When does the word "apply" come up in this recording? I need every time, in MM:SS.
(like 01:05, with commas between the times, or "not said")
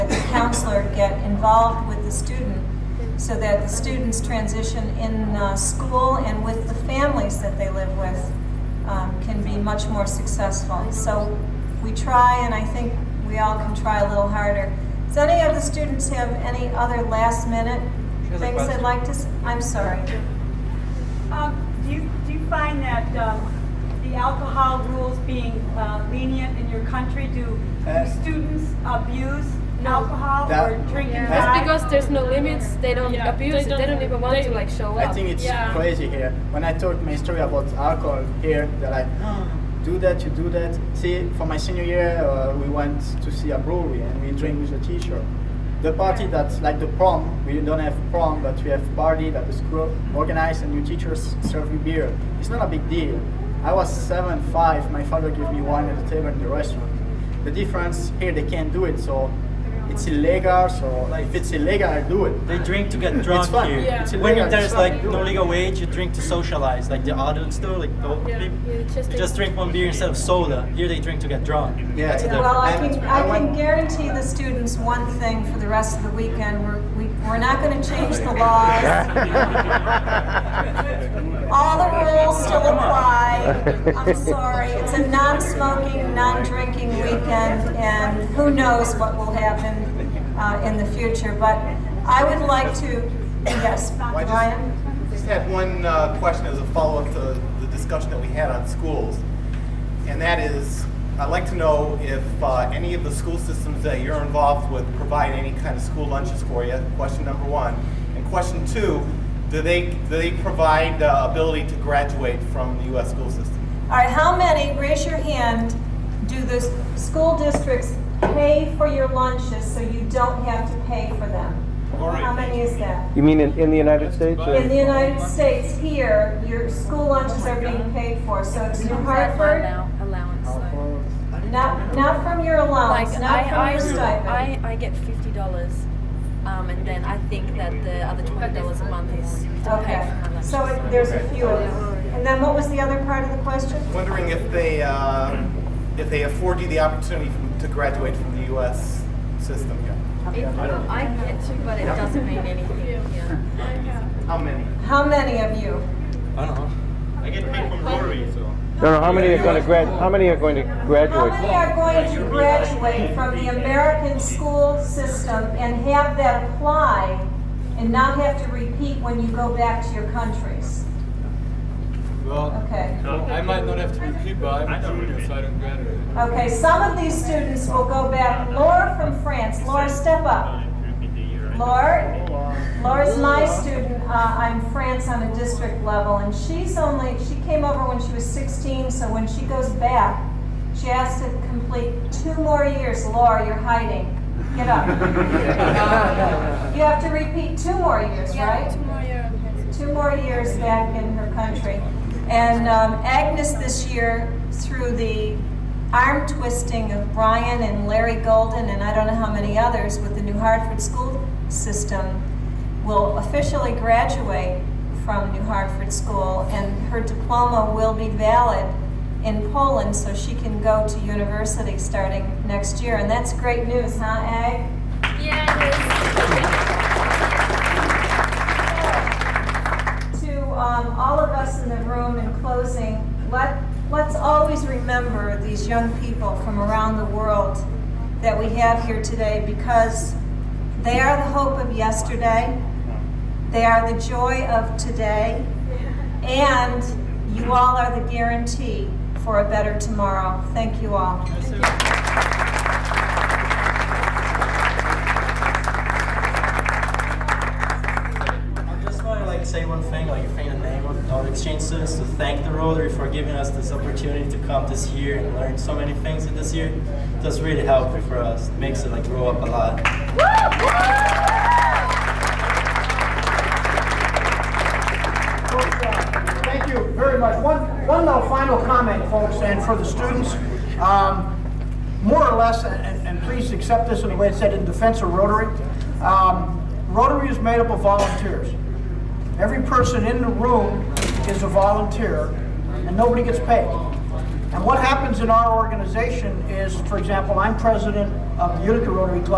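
01:22, 02:46.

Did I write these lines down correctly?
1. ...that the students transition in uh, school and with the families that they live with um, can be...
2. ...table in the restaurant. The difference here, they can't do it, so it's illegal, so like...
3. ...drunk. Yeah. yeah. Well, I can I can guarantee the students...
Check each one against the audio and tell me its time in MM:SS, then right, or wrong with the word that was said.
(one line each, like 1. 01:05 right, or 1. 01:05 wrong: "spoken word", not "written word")
1. 00:03 right
2. 00:56 right
3. 01:11 right.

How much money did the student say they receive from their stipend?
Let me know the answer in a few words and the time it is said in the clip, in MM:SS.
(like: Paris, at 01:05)
$50, at 02:14.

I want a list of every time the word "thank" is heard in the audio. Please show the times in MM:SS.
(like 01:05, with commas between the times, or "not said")
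04:10, 04:22, 04:36.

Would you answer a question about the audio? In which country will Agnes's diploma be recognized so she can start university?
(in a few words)
Poland.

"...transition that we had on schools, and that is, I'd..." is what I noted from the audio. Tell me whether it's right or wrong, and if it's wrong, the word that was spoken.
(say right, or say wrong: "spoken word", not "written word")
wrong: "discussion", not "transition".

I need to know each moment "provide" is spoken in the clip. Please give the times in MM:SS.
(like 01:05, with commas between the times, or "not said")
01:44, 01:50.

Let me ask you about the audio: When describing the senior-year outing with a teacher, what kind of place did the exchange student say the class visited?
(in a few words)
brewery.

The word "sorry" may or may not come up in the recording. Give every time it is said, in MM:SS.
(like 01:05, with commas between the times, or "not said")
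00:19, 01:24.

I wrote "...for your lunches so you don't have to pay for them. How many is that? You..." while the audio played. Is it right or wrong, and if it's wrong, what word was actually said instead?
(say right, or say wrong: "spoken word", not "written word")
right.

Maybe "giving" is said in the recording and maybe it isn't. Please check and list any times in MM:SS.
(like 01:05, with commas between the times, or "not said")
04:23.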